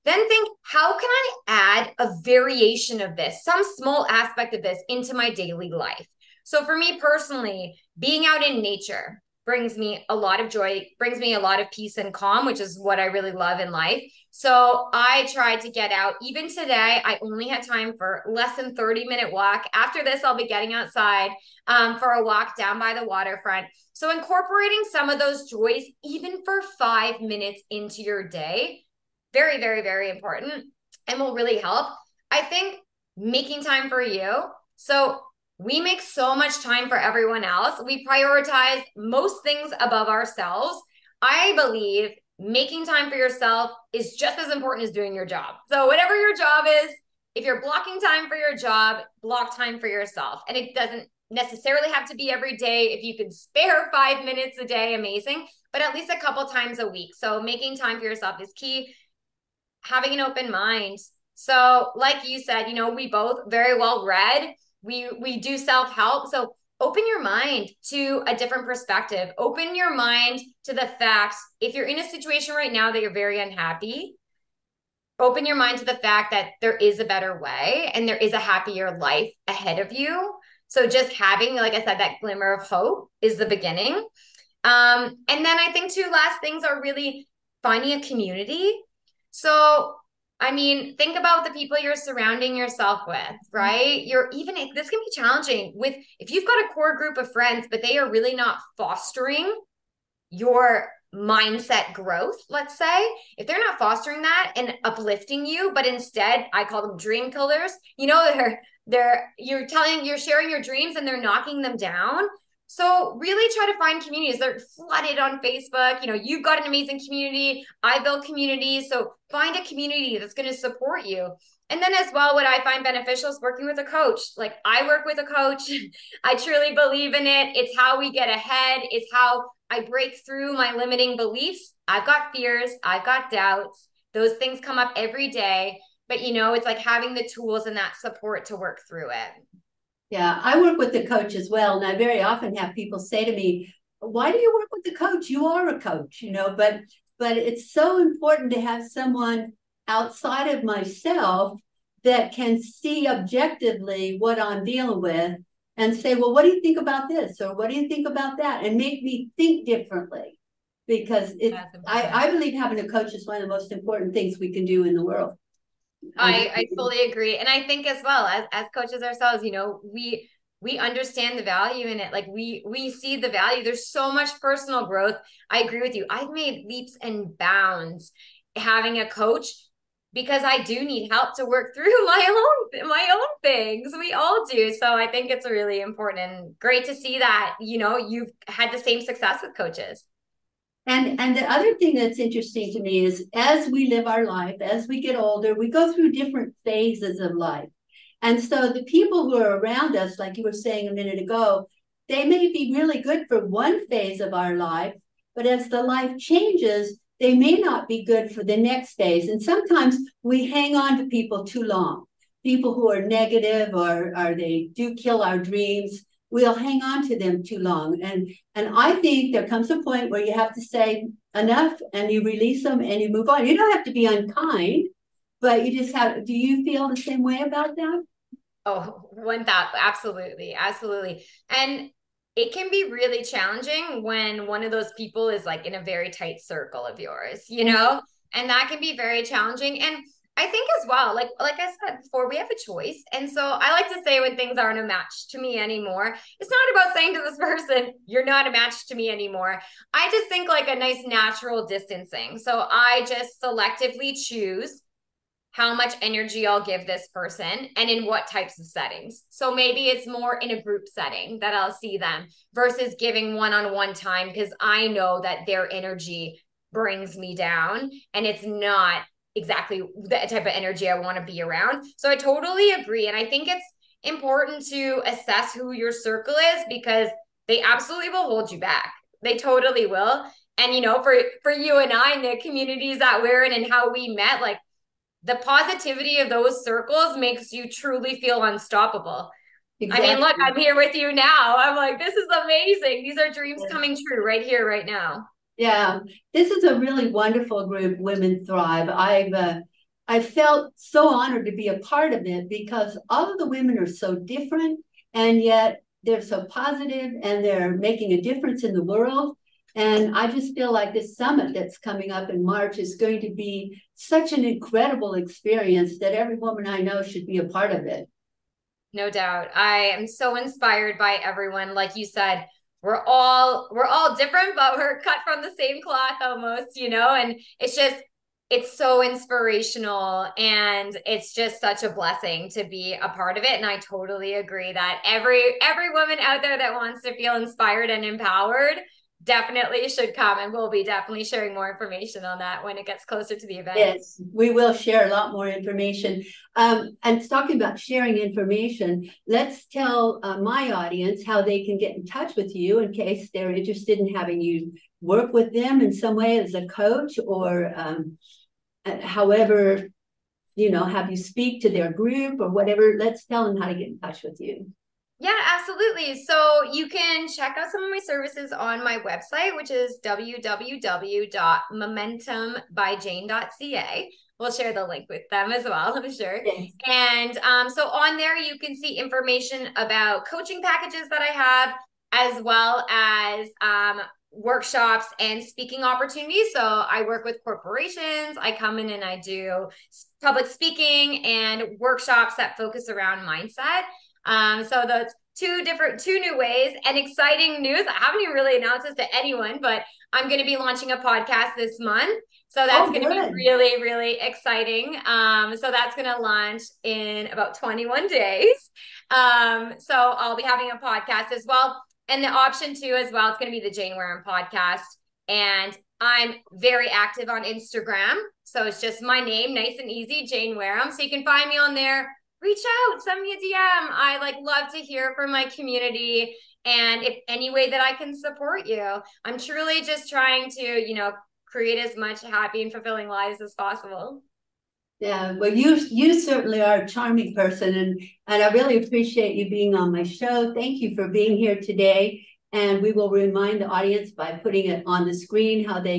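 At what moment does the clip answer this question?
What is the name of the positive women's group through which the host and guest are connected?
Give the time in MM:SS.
04:57.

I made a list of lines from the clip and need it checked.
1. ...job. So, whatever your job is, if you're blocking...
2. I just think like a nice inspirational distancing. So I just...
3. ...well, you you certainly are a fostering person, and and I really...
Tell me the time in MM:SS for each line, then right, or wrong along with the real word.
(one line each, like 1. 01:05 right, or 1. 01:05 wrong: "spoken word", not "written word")
1. 00:45 right
2. 04:09 wrong: "natural", not "inspirational"
3. 07:15 wrong: "charming", not "fostering".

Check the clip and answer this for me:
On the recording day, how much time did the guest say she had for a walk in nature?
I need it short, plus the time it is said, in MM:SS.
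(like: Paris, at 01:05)
less than 30 minutes, at 00:18.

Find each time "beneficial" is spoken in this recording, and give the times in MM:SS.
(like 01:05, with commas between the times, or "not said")
02:02.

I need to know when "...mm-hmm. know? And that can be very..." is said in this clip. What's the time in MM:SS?
03:57.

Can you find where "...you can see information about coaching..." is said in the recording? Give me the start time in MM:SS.
06:18.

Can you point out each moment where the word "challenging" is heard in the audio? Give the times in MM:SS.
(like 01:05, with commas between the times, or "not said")
01:35, 03:53, 03:59.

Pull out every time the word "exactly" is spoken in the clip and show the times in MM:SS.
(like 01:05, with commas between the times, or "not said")
04:29, 04:49.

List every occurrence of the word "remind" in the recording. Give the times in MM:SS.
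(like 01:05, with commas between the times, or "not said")
07:23.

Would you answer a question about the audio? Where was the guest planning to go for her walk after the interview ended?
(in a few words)
the waterfront.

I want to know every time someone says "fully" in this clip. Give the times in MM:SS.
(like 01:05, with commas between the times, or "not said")
02:46.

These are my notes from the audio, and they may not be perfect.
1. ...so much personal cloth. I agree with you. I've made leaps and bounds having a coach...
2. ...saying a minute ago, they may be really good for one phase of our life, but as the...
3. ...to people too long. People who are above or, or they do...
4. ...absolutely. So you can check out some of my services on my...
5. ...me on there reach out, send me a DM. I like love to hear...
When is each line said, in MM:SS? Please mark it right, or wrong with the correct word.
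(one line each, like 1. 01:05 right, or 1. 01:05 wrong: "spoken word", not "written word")
1. 02:53 wrong: "growth", not "cloth"
2. 03:20 right
3. 03:30 wrong: "negative", not "above"
4. 06:05 right
5. 07:01 right.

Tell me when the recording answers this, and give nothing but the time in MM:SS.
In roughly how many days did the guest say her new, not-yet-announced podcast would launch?
06:47.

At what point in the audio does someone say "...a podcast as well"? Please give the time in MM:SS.
06:50.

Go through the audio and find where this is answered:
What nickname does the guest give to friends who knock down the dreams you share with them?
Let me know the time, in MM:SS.
01:46.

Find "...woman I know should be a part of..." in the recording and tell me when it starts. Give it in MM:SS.
05:16.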